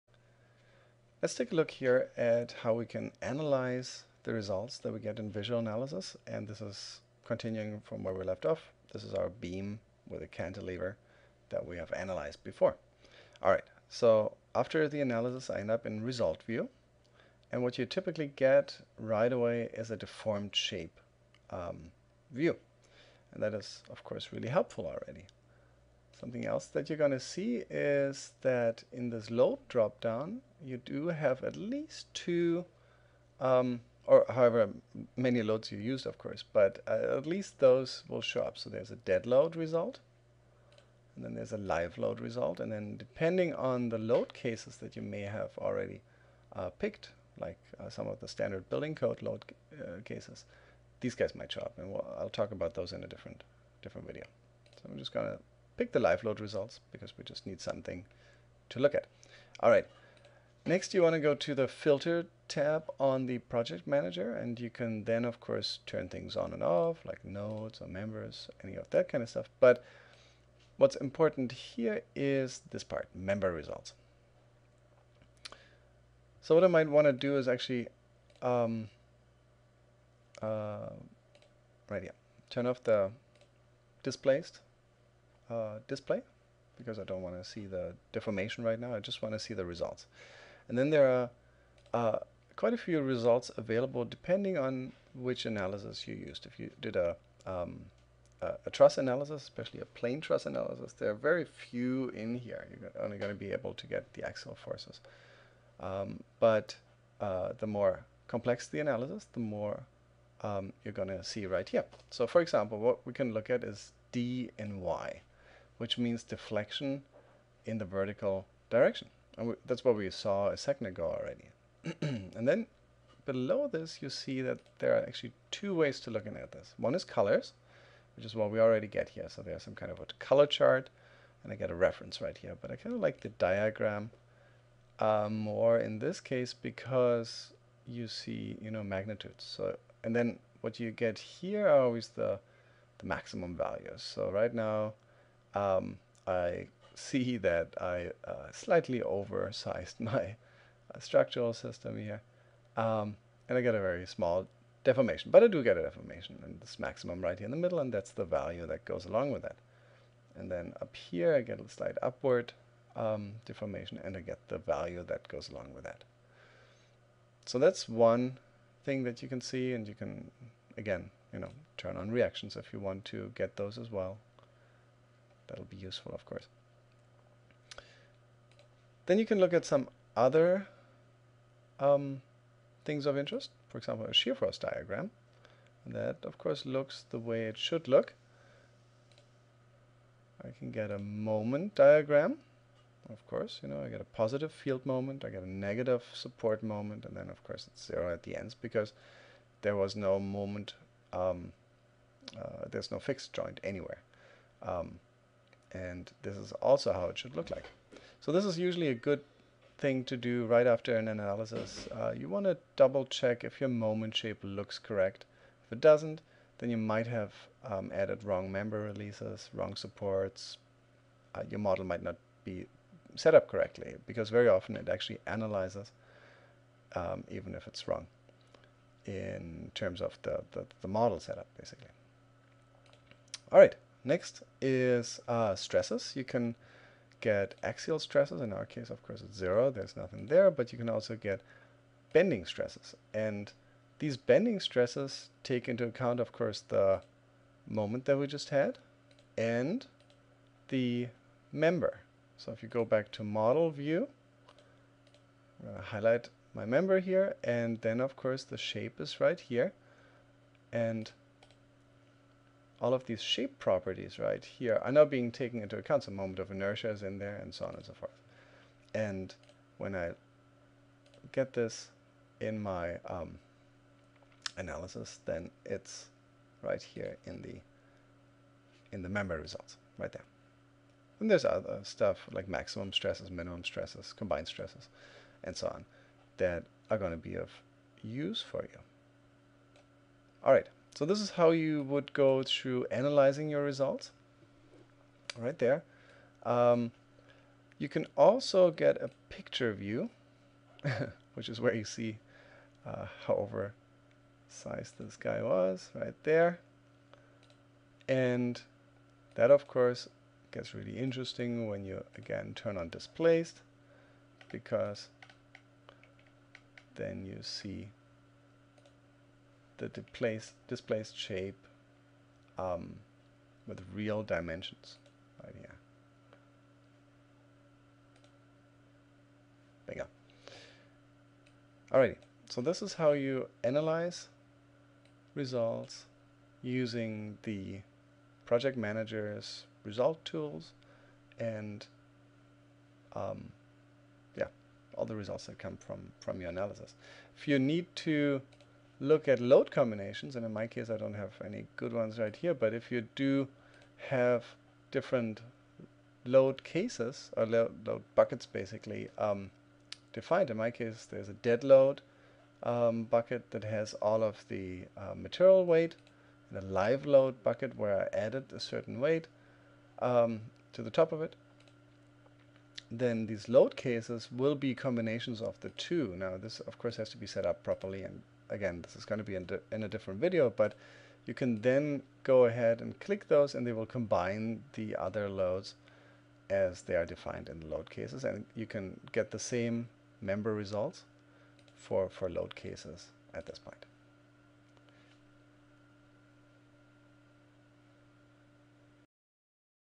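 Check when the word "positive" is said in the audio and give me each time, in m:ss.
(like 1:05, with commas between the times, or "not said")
3:14.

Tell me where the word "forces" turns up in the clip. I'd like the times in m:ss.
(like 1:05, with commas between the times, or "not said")
1:44, 3:04.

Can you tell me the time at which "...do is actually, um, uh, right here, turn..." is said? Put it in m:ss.
1:17.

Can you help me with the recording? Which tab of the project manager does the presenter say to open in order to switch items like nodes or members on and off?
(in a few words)
Filter tab.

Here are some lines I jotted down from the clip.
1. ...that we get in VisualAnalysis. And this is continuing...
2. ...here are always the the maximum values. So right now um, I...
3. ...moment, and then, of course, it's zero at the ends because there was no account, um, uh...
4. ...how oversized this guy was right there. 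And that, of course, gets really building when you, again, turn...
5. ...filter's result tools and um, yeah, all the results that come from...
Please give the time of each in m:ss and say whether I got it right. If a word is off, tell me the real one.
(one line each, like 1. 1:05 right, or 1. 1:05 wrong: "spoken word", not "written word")
1. 0:04 right
2. 2:21 right
3. 3:16 wrong: "moment", not "account"
4. 5:03 wrong: "interesting", not "building"
5. 5:38 wrong: "manager", not "filter".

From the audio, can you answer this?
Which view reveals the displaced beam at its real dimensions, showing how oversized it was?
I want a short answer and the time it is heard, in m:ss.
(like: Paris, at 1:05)
Picture view, at 4:59.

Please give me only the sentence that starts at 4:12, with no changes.
So if you go back to model view, I'm going to highlight my member here.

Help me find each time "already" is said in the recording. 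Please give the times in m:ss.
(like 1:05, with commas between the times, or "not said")
0:24, 0:45, 2:01, 2:08.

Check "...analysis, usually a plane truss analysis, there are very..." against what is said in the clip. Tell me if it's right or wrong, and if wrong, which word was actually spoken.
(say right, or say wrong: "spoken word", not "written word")
wrong: "especially", not "usually".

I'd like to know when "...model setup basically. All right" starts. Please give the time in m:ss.
3:50.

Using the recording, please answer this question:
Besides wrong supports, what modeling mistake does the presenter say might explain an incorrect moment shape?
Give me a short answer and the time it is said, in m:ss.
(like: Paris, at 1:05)
Wrong member releases, at 3:38.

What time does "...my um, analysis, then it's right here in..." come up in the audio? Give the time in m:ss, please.
4:32.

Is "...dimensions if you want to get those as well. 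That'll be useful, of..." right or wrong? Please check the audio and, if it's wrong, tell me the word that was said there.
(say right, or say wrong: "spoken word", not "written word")
wrong: "reactions", not "dimensions".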